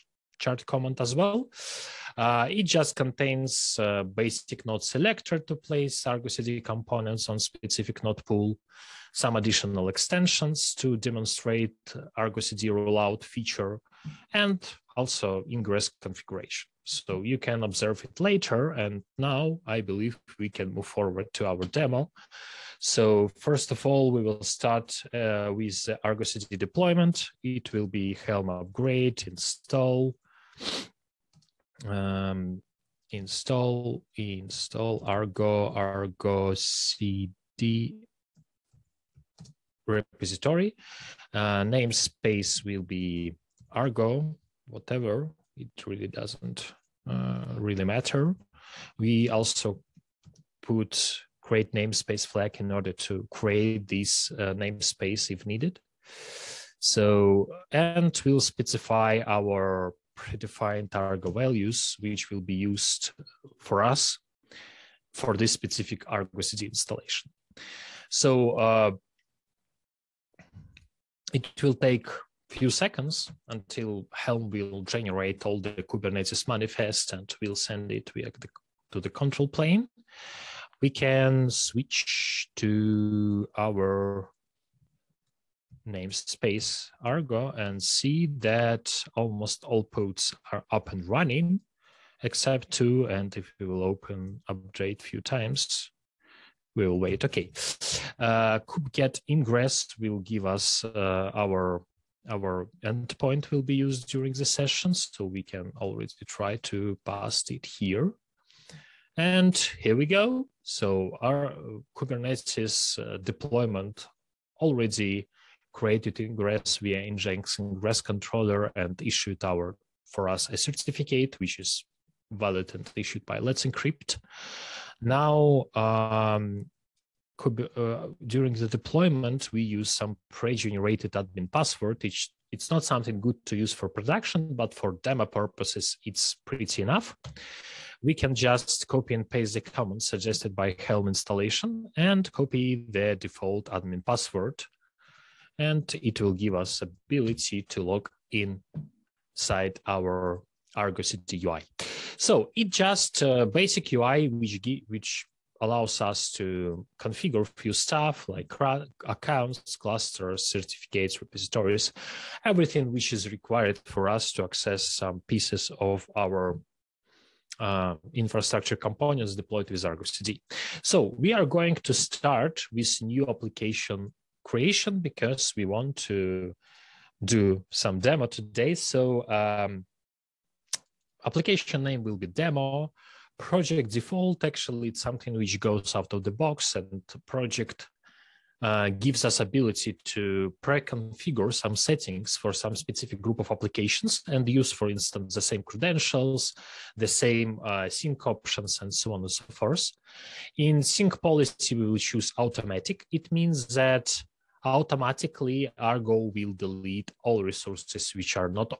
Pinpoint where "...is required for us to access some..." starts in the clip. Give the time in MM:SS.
02:43.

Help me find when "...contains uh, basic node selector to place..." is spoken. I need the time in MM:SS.
00:02.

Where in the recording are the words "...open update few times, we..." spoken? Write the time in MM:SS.
01:33.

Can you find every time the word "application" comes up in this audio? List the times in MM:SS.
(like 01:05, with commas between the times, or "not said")
02:53, 03:01, 03:13.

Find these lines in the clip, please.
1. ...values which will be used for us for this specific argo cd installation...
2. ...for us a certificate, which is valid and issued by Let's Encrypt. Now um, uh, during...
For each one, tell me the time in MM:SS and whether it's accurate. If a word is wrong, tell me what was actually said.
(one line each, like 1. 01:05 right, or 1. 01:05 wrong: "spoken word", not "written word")
1. 01:01 right
2. 02:00 right.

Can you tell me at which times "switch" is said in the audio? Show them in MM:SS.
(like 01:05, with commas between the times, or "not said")
01:21.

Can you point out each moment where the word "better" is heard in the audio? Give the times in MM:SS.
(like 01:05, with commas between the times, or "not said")
not said.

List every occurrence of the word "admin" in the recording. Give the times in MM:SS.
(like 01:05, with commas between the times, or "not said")
02:11, 02:23.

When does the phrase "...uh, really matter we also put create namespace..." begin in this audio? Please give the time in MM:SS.
00:47.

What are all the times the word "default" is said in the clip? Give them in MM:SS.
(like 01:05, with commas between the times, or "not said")
02:23, 03:03.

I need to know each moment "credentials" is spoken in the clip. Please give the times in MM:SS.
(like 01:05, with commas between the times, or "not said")
03:15.